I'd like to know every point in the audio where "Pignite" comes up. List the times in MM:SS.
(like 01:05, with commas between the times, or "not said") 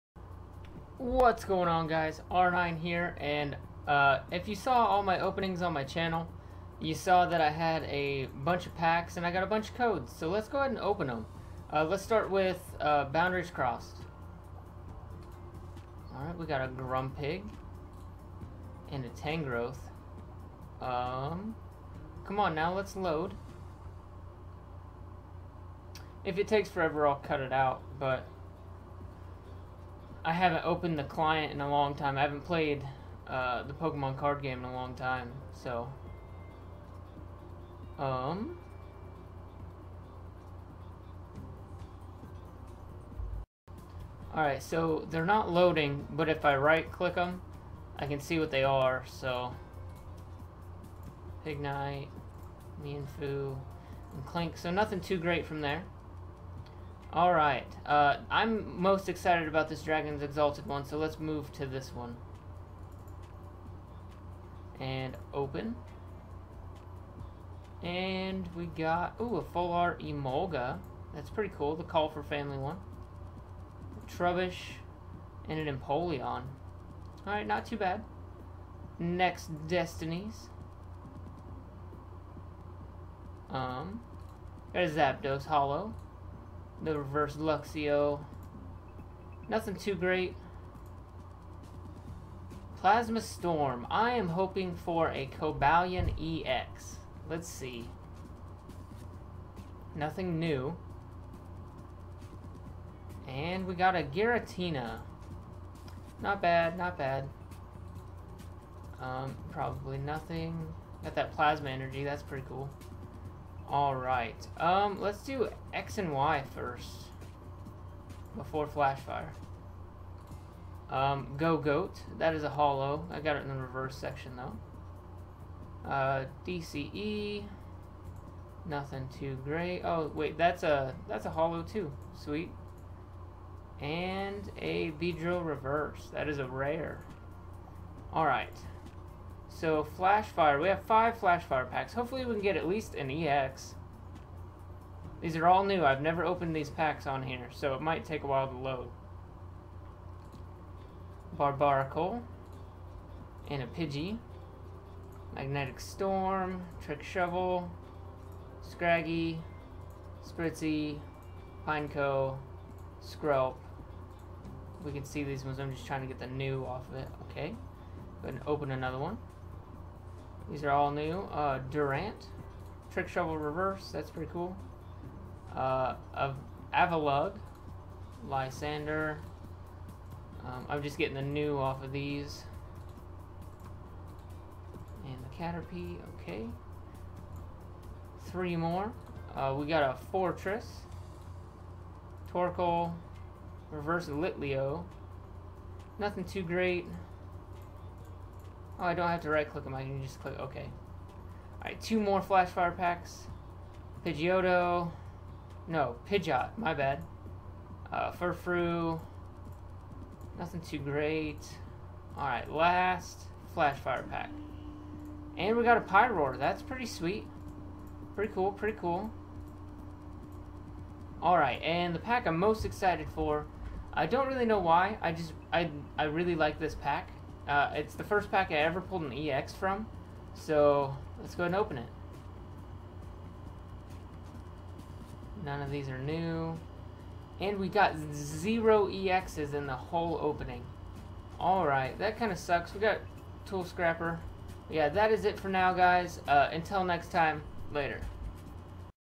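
00:51.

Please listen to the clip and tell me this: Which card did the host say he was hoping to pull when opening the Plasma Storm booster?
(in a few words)
Cobalion EX.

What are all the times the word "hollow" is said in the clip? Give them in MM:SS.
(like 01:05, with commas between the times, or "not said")
01:25, 02:02, 02:11.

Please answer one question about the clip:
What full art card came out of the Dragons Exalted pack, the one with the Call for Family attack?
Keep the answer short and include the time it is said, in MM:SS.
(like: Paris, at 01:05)
Emolga, at 01:10.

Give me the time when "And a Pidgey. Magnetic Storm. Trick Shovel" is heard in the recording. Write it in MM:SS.
02:33.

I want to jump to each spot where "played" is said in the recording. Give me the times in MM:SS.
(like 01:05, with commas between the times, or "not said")
00:32.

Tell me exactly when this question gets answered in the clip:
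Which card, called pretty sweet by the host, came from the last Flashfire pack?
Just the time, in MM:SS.
03:35.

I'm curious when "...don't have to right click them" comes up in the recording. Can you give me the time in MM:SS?
03:18.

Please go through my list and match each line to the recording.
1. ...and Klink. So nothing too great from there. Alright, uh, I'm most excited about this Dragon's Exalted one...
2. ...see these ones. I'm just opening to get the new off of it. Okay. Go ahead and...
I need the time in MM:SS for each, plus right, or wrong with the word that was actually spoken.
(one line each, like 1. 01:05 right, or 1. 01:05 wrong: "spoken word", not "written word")
1. 00:54 right
2. 02:45 wrong: "trying", not "opening".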